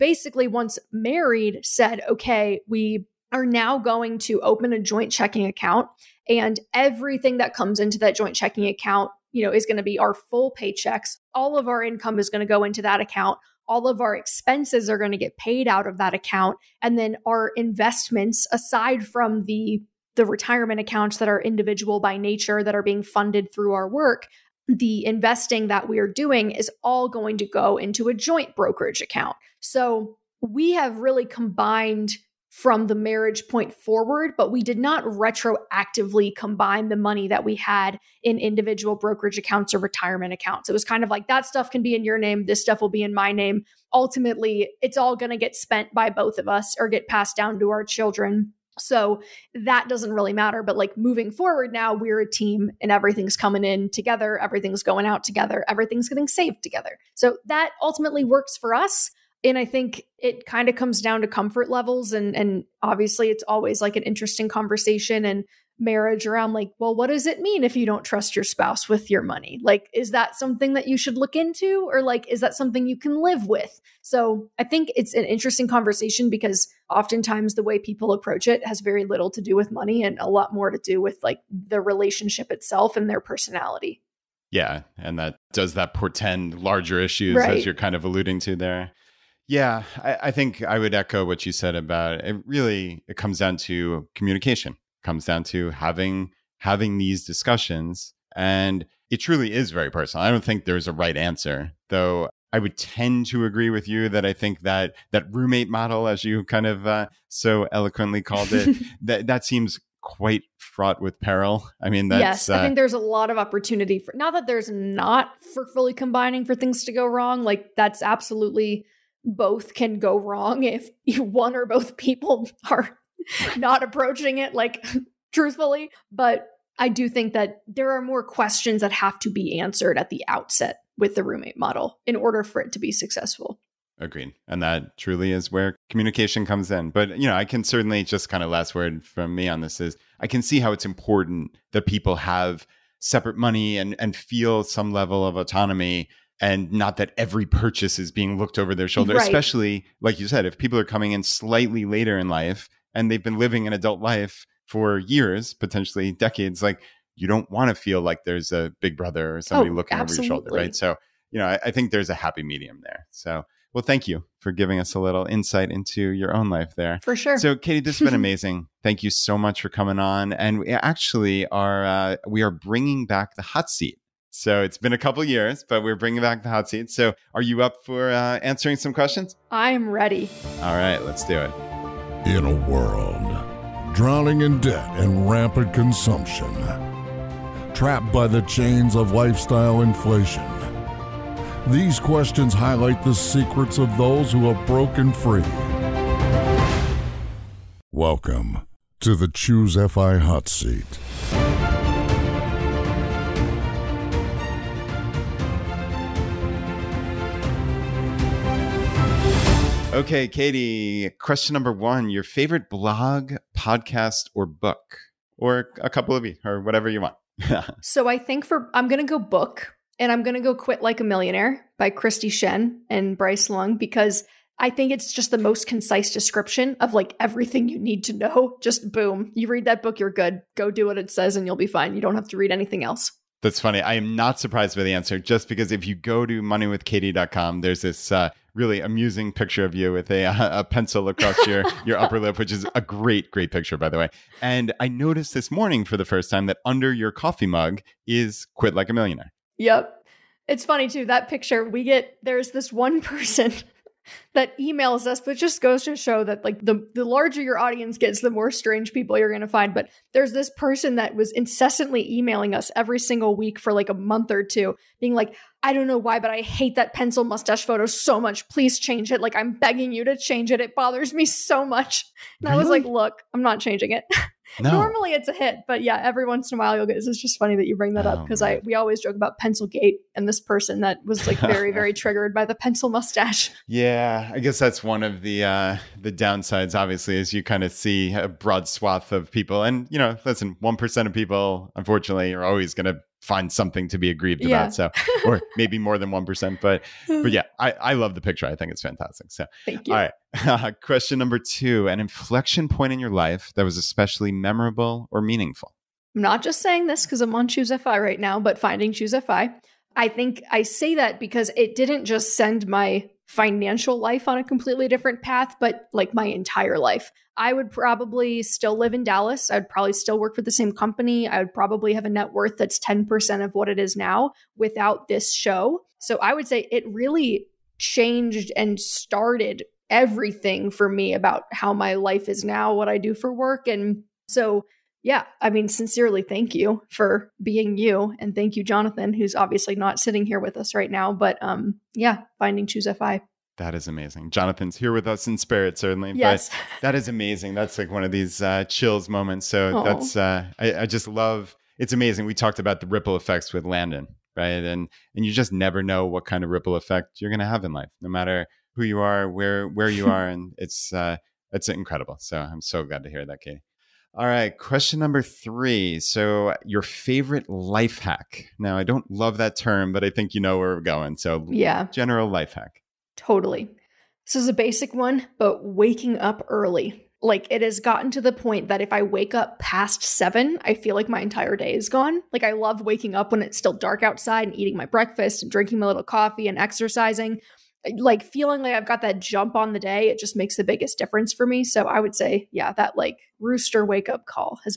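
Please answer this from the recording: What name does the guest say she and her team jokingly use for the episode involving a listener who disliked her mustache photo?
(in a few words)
pencil gate.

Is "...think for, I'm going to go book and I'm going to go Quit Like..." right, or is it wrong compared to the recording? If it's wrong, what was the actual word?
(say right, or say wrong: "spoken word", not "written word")
right.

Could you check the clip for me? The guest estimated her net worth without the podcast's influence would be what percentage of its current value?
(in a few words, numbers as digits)
10%.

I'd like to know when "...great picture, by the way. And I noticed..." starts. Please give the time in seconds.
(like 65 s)
243 s.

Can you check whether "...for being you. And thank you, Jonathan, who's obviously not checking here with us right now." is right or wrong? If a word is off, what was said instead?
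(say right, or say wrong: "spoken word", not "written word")
wrong: "sitting", not "checking".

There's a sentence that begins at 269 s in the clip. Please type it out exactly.
Like, I'm begging you to change it.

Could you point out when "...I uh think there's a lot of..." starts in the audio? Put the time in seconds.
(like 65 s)
112 s.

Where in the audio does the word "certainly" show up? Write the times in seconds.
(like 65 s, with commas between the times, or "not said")
137 s, 345 s.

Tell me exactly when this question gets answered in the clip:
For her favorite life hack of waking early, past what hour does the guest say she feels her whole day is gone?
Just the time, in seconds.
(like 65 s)
380 s.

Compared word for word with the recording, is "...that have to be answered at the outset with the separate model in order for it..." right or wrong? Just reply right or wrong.
wrong.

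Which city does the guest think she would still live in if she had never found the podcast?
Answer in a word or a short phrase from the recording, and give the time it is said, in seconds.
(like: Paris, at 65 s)
Dallas, at 319 s.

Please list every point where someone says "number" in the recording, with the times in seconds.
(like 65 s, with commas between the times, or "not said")
211 s, 301 s, 364 s.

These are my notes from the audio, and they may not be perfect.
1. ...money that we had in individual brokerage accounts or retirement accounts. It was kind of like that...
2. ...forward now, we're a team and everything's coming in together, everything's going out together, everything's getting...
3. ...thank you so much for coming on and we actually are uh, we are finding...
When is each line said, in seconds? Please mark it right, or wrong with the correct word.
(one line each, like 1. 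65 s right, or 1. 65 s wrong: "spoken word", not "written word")
1. 36 s right
2. 51 s right
3. 168 s wrong: "bringing", not "finding".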